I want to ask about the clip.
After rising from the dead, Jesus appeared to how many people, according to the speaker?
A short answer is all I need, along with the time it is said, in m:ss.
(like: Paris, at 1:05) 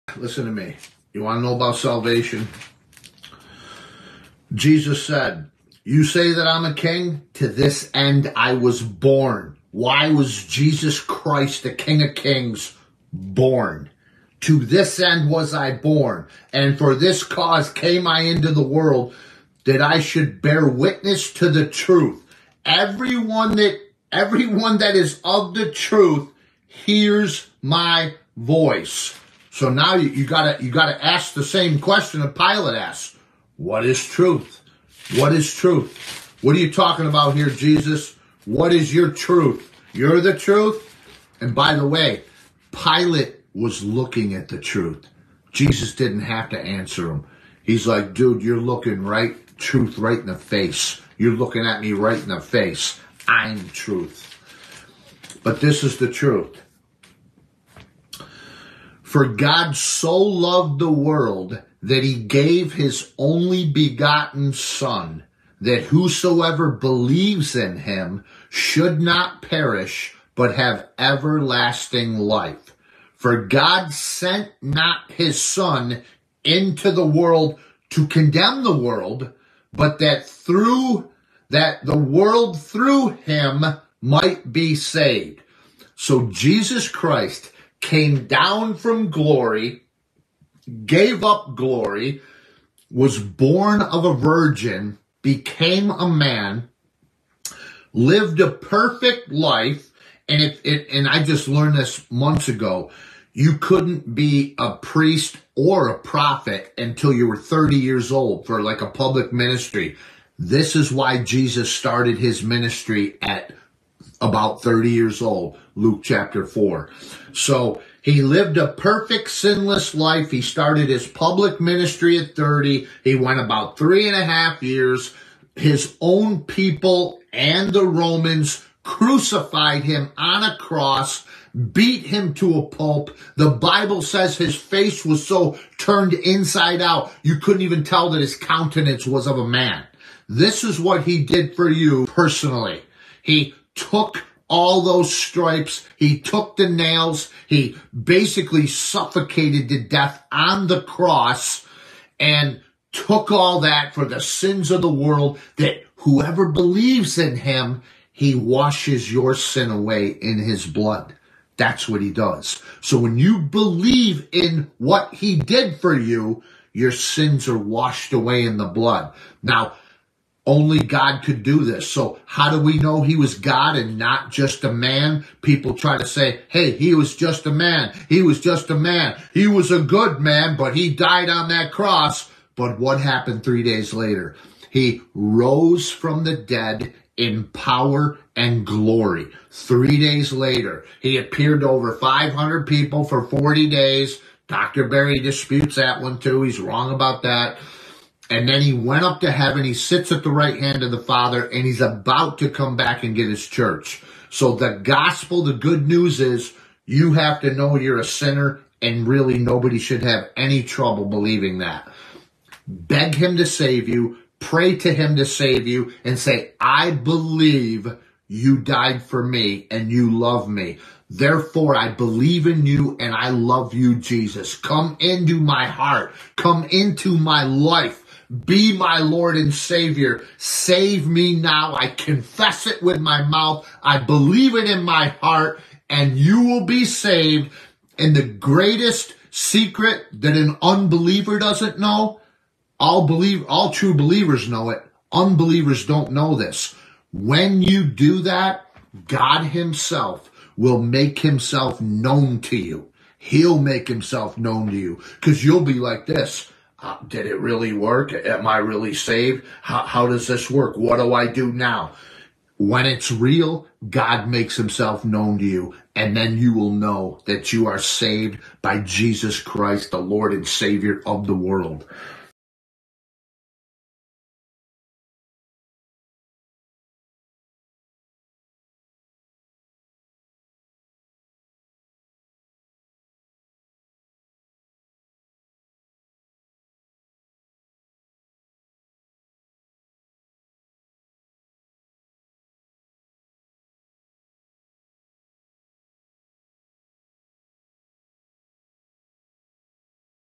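over 500, at 3:11.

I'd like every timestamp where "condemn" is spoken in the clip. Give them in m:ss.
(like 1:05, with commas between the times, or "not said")
1:18.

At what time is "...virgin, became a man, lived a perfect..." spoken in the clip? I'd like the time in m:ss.
1:34.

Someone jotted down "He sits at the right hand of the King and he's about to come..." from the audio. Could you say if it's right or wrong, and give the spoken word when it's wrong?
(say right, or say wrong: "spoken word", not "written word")
wrong: "Father", not "King".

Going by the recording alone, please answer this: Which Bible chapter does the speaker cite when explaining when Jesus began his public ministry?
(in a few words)
Luke chapter 4.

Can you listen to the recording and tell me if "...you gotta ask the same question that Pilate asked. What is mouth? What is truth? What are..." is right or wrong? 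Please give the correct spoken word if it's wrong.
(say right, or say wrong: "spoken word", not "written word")
wrong: "truth", not "mouth".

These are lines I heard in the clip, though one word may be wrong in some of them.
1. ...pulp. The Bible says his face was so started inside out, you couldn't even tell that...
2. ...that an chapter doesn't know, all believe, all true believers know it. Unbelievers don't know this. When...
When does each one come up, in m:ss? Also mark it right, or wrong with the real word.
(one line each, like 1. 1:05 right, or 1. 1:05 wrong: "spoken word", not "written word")
1. 2:12 wrong: "turned", not "started"
2. 4:00 wrong: "unbeliever", not "chapter".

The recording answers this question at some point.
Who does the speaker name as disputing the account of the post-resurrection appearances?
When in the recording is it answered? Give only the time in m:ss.
3:14.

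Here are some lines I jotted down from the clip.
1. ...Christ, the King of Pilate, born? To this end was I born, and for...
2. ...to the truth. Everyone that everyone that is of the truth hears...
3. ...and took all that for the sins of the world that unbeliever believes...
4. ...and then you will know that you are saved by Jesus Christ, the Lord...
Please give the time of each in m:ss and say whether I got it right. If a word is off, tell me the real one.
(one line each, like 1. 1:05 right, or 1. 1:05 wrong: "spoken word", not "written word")
1. 0:10 wrong: "Kings", not "Pilate"
2. 0:21 right
3. 2:32 wrong: "whoever", not "unbeliever"
4. 4:25 right.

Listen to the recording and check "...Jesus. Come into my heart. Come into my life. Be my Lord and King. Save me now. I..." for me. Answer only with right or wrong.
wrong.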